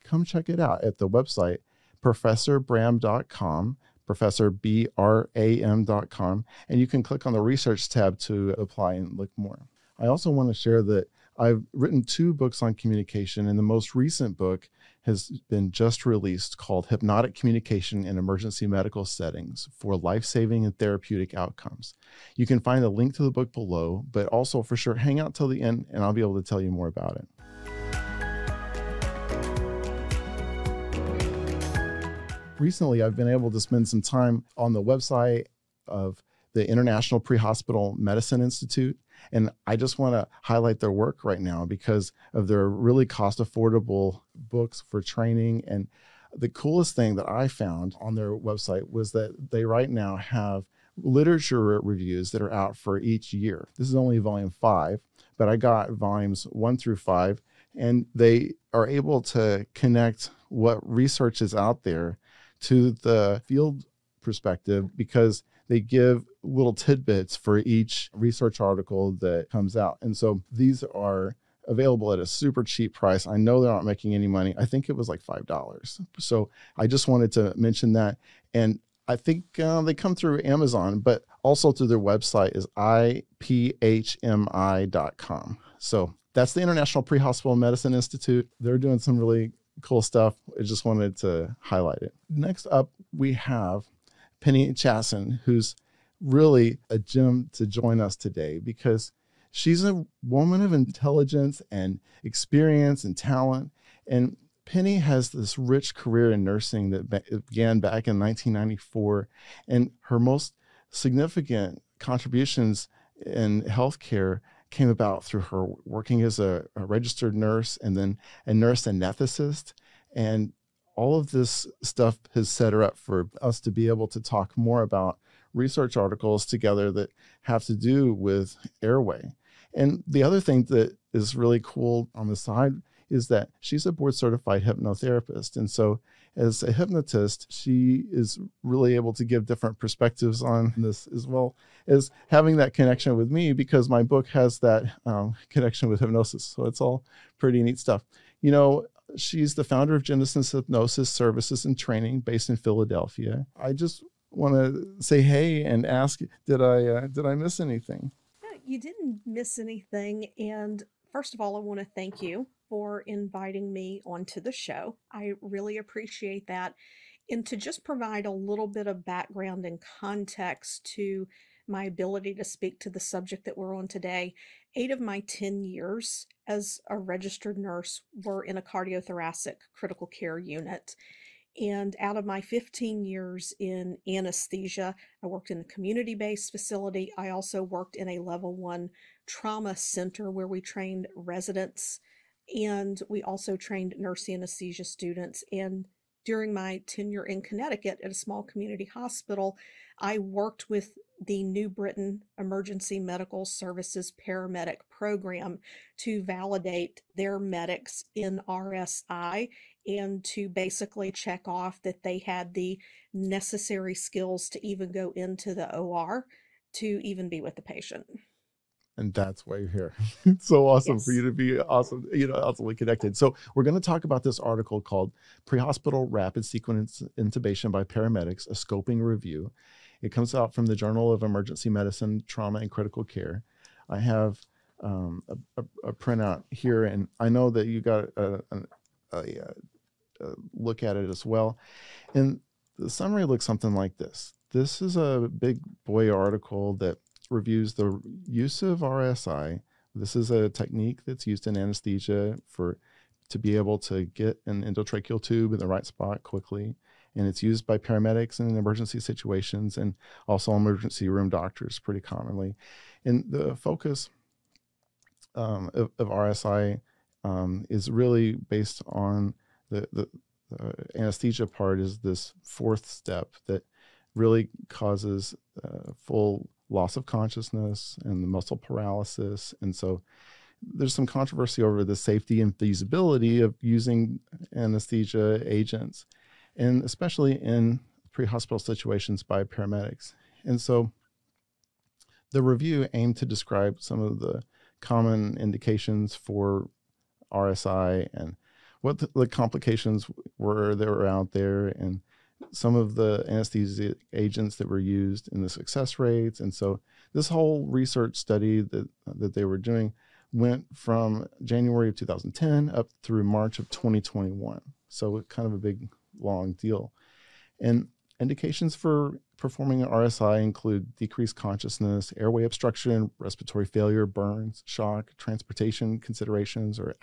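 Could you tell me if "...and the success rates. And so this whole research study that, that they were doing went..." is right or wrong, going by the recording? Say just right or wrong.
right.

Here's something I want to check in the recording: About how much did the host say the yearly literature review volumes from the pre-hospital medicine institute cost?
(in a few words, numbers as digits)
$5.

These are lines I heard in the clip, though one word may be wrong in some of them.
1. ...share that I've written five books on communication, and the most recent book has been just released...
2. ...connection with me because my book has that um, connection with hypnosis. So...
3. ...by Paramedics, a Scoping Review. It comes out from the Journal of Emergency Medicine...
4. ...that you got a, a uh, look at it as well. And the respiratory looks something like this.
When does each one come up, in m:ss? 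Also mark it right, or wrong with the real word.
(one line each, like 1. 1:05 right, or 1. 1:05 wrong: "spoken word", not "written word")
1. 0:10 wrong: "two", not "five"
2. 2:22 right
3. 3:47 right
4. 3:57 wrong: "summary", not "respiratory".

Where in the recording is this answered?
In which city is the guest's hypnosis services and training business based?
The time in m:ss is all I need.
2:32.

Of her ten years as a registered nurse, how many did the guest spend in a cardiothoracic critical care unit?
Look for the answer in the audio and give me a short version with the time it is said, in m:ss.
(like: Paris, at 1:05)
8, at 2:54.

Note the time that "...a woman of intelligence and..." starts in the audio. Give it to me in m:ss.
1:39.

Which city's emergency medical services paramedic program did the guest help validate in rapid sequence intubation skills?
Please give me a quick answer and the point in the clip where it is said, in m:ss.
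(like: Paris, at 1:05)
New Britain, at 3:21.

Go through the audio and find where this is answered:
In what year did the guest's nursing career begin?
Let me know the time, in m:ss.
1:48.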